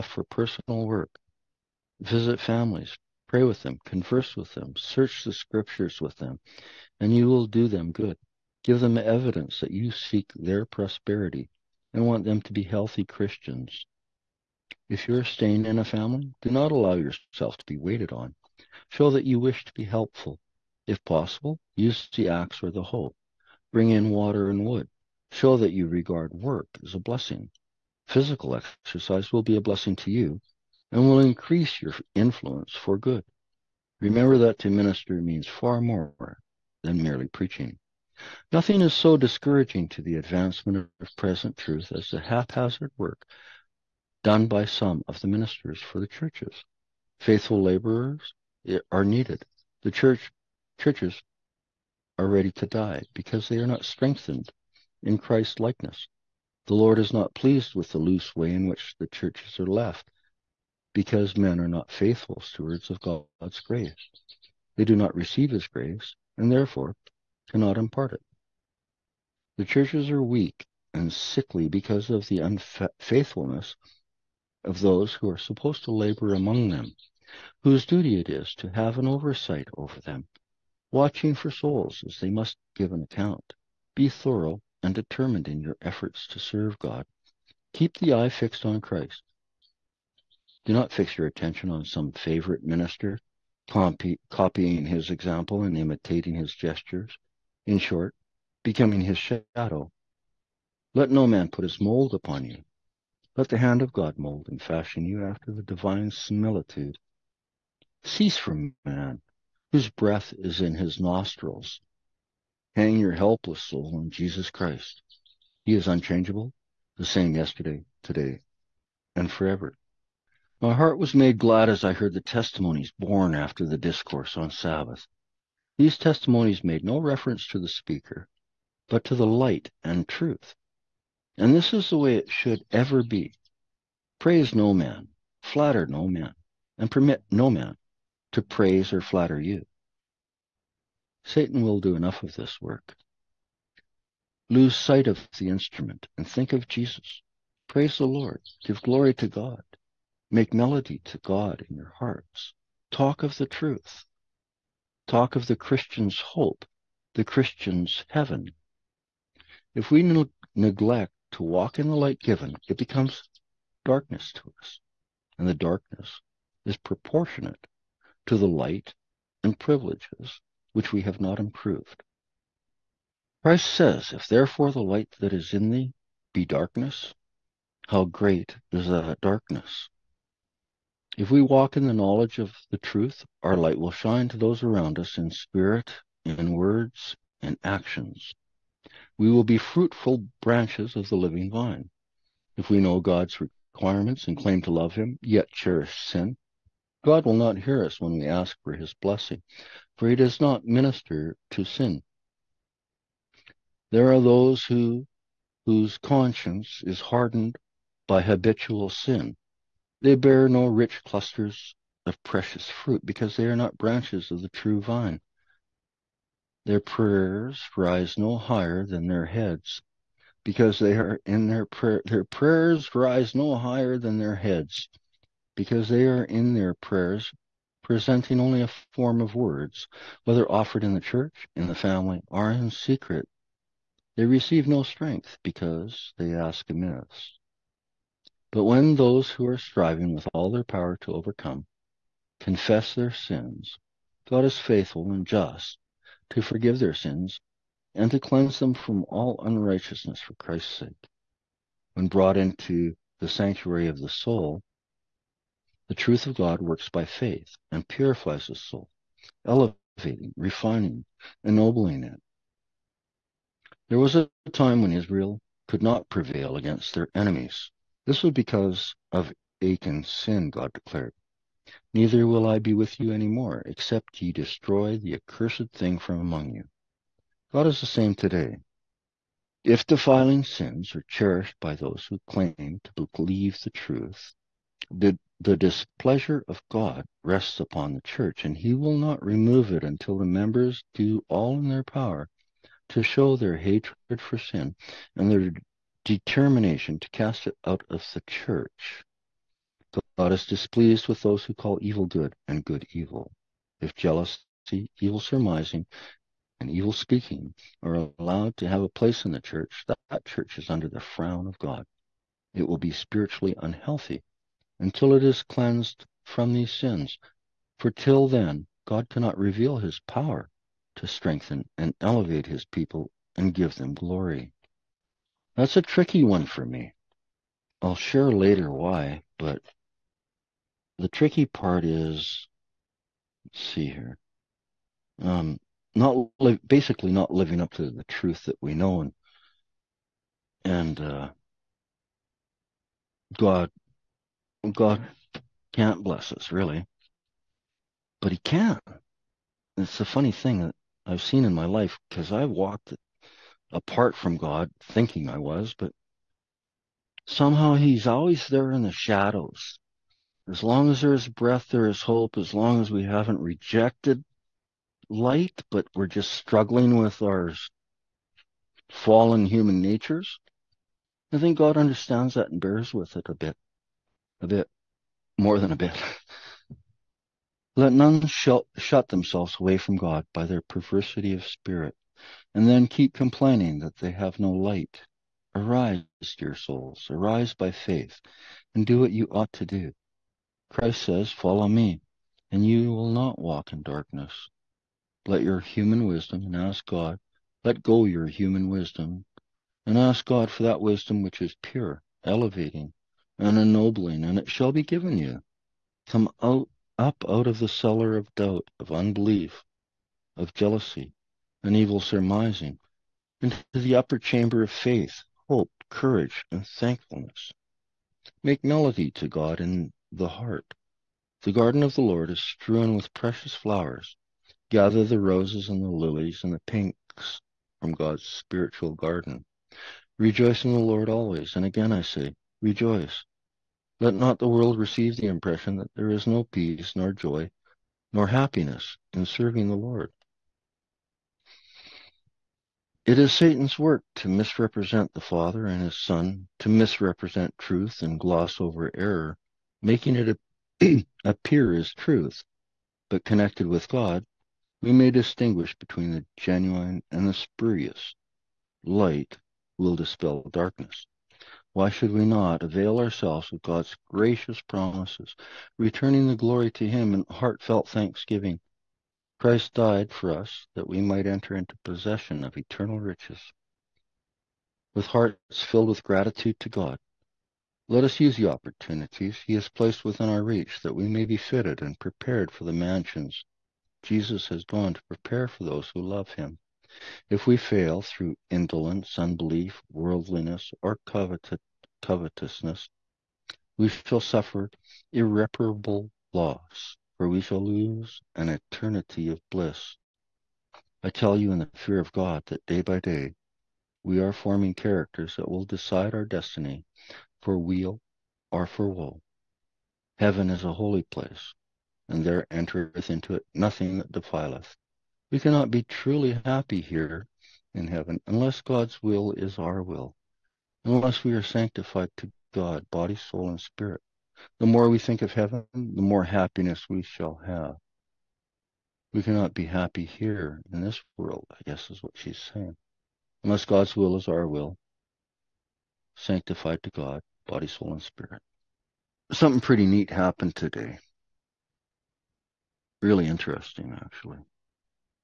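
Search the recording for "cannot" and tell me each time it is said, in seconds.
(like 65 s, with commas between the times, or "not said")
67 s, 319 s, 515 s, 529 s.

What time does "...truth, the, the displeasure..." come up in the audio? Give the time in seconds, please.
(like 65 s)
283 s.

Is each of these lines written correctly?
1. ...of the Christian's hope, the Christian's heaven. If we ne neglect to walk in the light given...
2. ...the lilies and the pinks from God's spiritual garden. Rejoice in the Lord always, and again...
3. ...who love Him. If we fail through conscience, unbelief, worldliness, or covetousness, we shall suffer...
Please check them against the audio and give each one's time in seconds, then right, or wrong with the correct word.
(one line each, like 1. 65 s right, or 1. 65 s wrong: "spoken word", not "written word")
1. 155 s right
2. 425 s right
3. 485 s wrong: "indolence", not "conscience".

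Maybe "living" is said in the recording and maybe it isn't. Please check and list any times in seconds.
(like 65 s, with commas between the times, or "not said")
191 s, 337 s.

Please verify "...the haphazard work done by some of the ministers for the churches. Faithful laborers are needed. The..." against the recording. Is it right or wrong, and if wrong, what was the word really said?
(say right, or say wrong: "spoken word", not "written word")
right.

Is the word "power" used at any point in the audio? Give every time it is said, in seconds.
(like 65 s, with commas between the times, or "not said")
240 s, 291 s, 320 s.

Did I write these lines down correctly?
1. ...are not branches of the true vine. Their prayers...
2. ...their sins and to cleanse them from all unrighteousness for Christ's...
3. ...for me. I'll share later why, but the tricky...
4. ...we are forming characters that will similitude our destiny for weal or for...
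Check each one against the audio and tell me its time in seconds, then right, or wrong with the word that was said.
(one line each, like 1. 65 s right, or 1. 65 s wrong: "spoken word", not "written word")
1. 213 s right
2. 246 s right
3. 326 s right
4. 504 s wrong: "decide", not "similitude".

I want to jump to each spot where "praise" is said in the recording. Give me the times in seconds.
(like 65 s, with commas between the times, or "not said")
134 s, 138 s, 147 s.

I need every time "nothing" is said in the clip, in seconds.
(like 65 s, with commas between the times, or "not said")
38 s, 513 s.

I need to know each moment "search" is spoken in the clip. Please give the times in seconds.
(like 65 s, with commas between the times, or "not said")
4 s.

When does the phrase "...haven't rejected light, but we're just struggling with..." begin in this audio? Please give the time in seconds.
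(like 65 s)
363 s.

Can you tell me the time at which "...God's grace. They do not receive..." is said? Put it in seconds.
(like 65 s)
63 s.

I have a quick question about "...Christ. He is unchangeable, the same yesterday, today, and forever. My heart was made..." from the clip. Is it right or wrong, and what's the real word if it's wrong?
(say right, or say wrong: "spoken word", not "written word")
right.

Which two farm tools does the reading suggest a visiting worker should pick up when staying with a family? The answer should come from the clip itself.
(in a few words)
the axe or the hoe.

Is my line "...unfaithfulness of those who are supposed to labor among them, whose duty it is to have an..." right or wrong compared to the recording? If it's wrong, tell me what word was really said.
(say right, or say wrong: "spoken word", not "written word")
right.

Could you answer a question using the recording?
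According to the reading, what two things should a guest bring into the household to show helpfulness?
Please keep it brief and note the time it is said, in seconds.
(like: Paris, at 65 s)
water and wood, at 24 s.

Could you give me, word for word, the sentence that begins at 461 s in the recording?
Why should we not avail ourselves of God's gracious promises, returning the glory to Him in heartfelt thanksgiving?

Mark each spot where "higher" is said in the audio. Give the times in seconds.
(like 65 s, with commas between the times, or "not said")
218 s, 223 s.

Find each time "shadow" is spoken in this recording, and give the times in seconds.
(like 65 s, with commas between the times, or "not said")
99 s, 358 s.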